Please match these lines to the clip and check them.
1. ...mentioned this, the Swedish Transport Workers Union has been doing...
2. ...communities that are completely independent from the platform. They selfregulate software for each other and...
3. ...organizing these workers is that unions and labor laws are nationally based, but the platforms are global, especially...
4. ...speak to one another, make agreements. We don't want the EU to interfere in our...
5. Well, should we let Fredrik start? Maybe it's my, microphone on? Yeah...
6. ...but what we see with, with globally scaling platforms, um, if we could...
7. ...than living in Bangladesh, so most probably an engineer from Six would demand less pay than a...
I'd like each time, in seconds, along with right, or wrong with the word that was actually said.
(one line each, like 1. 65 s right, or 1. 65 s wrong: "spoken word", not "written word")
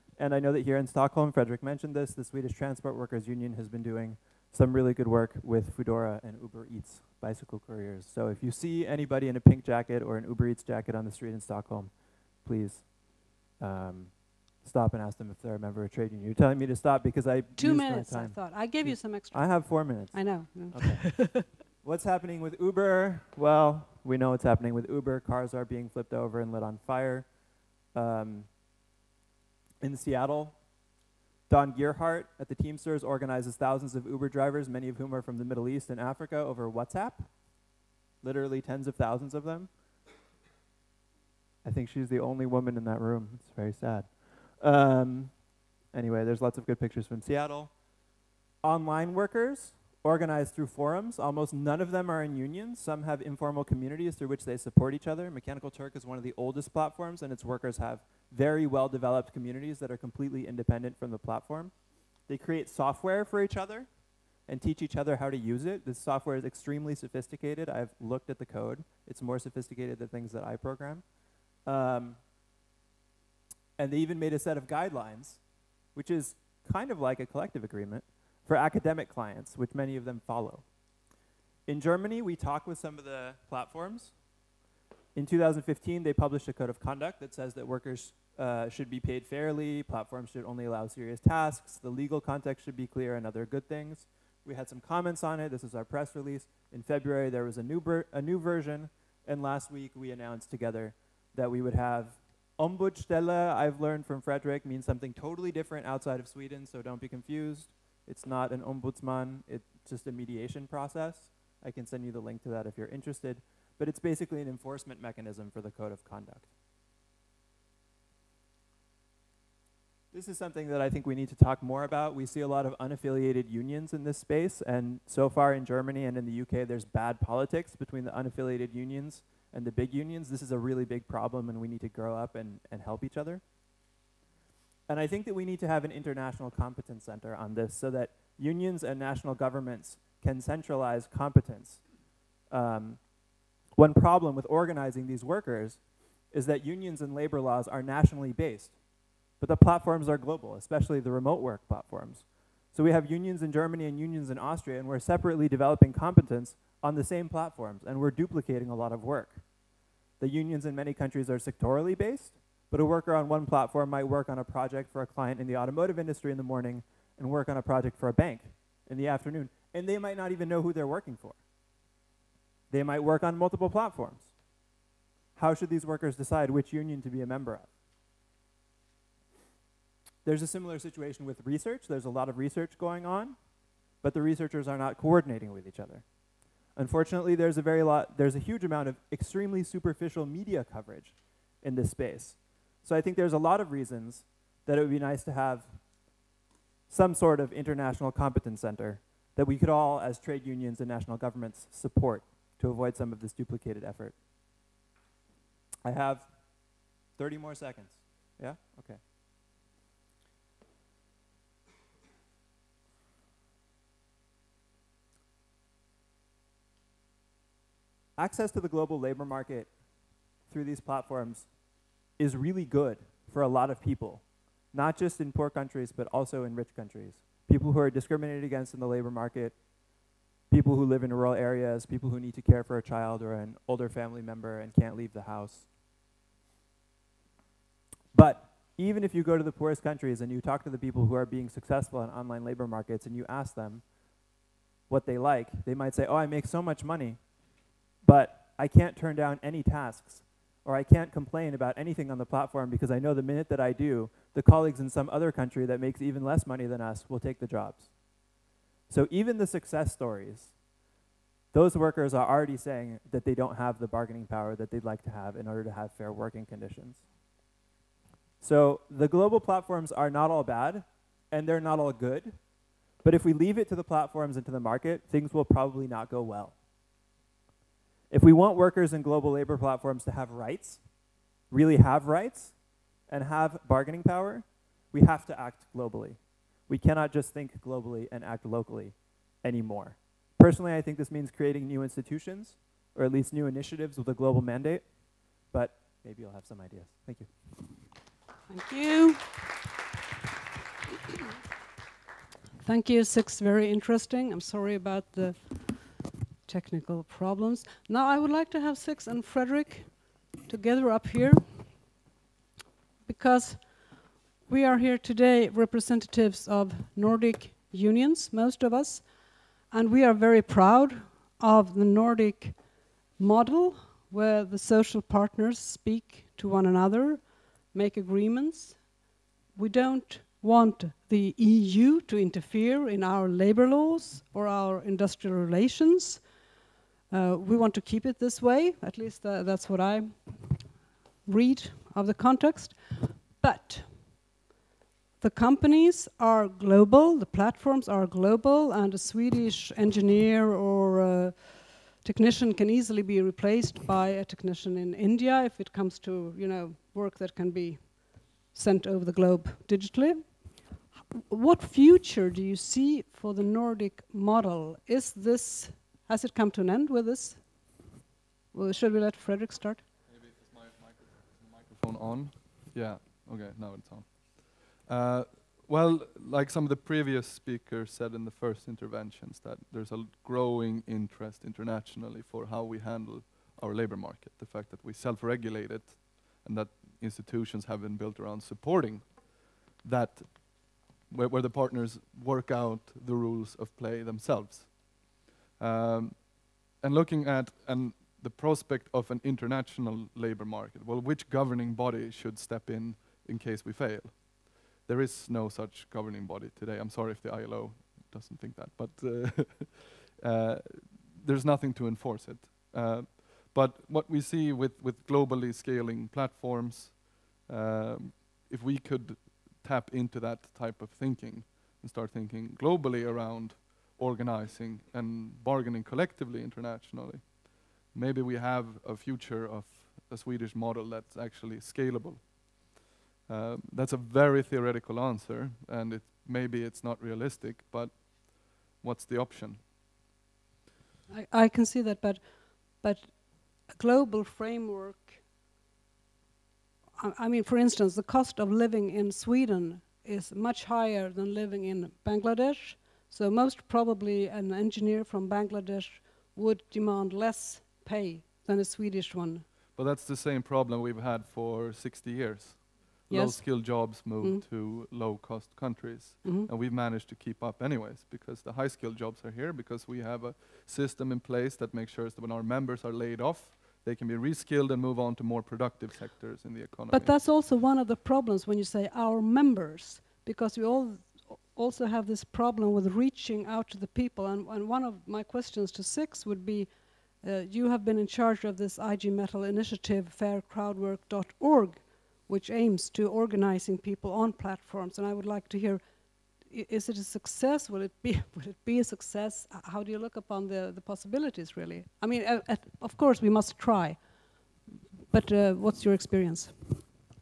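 1. 1 s right
2. 59 s wrong: "create", not "selfregulate"
3. 144 s right
4. 325 s right
5. 368 s right
6. 413 s right
7. 451 s wrong: "Bangladesh", not "Six".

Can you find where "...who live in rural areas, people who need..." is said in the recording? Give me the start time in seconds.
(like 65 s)
230 s.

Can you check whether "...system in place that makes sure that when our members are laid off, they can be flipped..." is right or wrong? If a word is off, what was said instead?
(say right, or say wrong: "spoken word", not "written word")
wrong: "reskilled", not "flipped".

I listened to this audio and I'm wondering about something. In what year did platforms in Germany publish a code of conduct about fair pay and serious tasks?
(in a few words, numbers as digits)
2015.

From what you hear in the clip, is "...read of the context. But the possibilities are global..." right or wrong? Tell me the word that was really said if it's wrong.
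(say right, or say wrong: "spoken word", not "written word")
wrong: "companies", not "possibilities".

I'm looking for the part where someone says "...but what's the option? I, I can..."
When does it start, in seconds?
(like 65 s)
437 s.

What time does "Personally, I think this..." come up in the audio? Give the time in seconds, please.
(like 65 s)
290 s.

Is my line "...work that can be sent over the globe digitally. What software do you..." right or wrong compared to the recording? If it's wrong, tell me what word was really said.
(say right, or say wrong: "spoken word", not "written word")
wrong: "future", not "software".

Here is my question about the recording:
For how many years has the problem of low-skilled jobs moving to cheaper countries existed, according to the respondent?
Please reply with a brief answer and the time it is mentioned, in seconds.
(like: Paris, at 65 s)
60, at 461 s.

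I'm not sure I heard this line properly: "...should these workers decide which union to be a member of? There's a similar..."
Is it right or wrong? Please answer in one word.
right.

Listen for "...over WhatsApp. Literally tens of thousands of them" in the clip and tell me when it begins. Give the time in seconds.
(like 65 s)
36 s.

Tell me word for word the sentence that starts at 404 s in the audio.
There is no such governing body today.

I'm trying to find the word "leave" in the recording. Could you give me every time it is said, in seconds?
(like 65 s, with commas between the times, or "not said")
234 s, 273 s.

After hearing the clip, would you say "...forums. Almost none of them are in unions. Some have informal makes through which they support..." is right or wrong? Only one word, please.
wrong.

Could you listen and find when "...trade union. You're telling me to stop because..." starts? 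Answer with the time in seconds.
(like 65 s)
15 s.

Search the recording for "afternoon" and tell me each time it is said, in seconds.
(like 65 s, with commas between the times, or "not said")
169 s.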